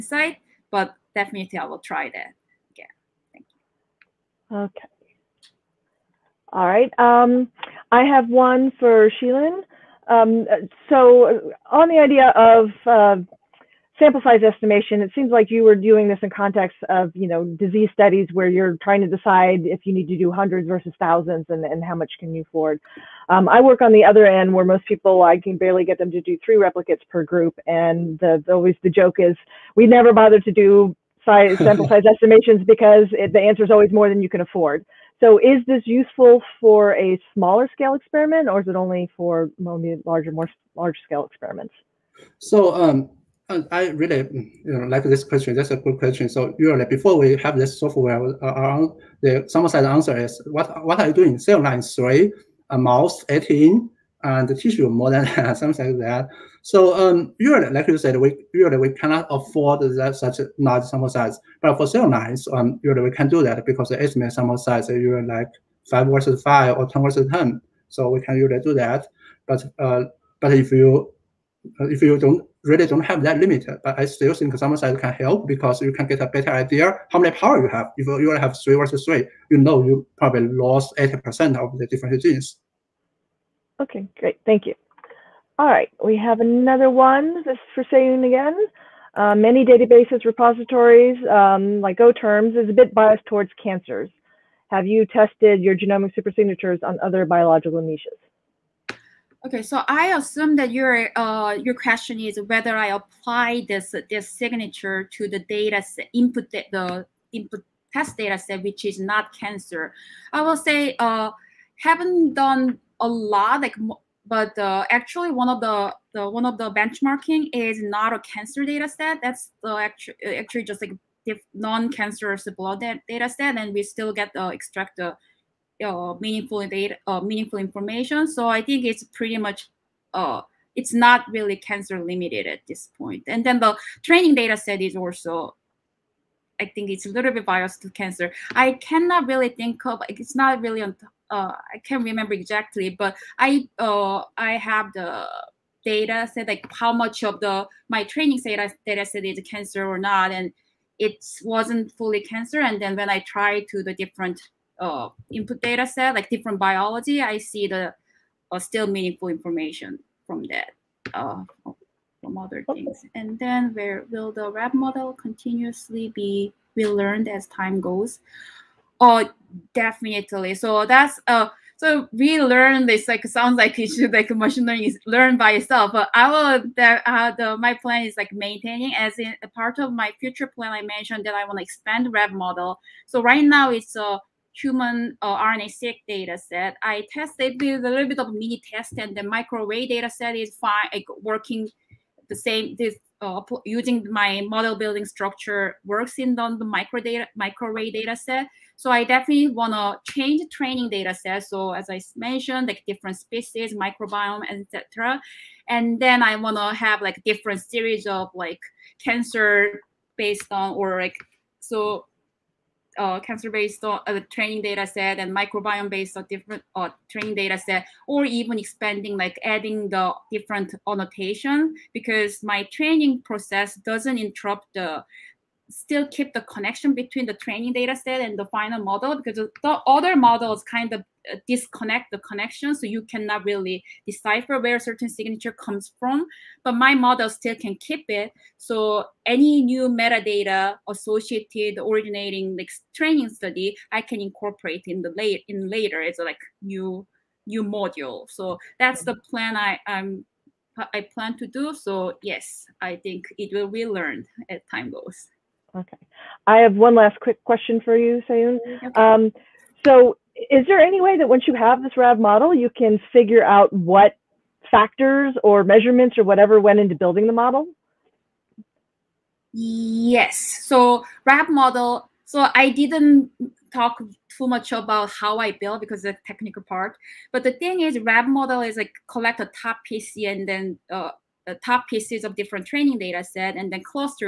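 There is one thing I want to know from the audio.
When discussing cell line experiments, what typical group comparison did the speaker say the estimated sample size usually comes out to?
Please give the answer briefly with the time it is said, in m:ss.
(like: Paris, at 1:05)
5 versus 5, at 1:05.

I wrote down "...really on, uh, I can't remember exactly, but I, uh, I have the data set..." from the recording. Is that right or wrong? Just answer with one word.
right.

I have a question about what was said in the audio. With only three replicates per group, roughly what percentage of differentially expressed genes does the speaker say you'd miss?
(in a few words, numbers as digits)
80%.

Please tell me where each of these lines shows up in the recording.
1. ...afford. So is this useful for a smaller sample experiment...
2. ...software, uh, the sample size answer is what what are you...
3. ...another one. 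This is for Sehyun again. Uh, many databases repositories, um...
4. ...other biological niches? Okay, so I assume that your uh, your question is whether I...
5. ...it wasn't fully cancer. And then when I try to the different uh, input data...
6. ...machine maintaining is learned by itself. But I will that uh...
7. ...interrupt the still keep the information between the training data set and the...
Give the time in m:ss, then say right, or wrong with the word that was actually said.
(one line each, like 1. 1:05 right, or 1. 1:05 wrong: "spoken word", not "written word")
1. 0:34 wrong: "scale", not "sample"
2. 0:47 right
3. 1:26 right
4. 1:37 right
5. 2:30 right
6. 2:54 wrong: "learning", not "maintaining"
7. 3:44 wrong: "connection", not "information".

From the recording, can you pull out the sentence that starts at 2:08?
So I think it's pretty much, uh, it's not really cancer limited at this point.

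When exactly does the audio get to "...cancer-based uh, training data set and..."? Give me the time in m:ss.
3:33.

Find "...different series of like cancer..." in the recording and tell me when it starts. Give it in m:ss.
3:27.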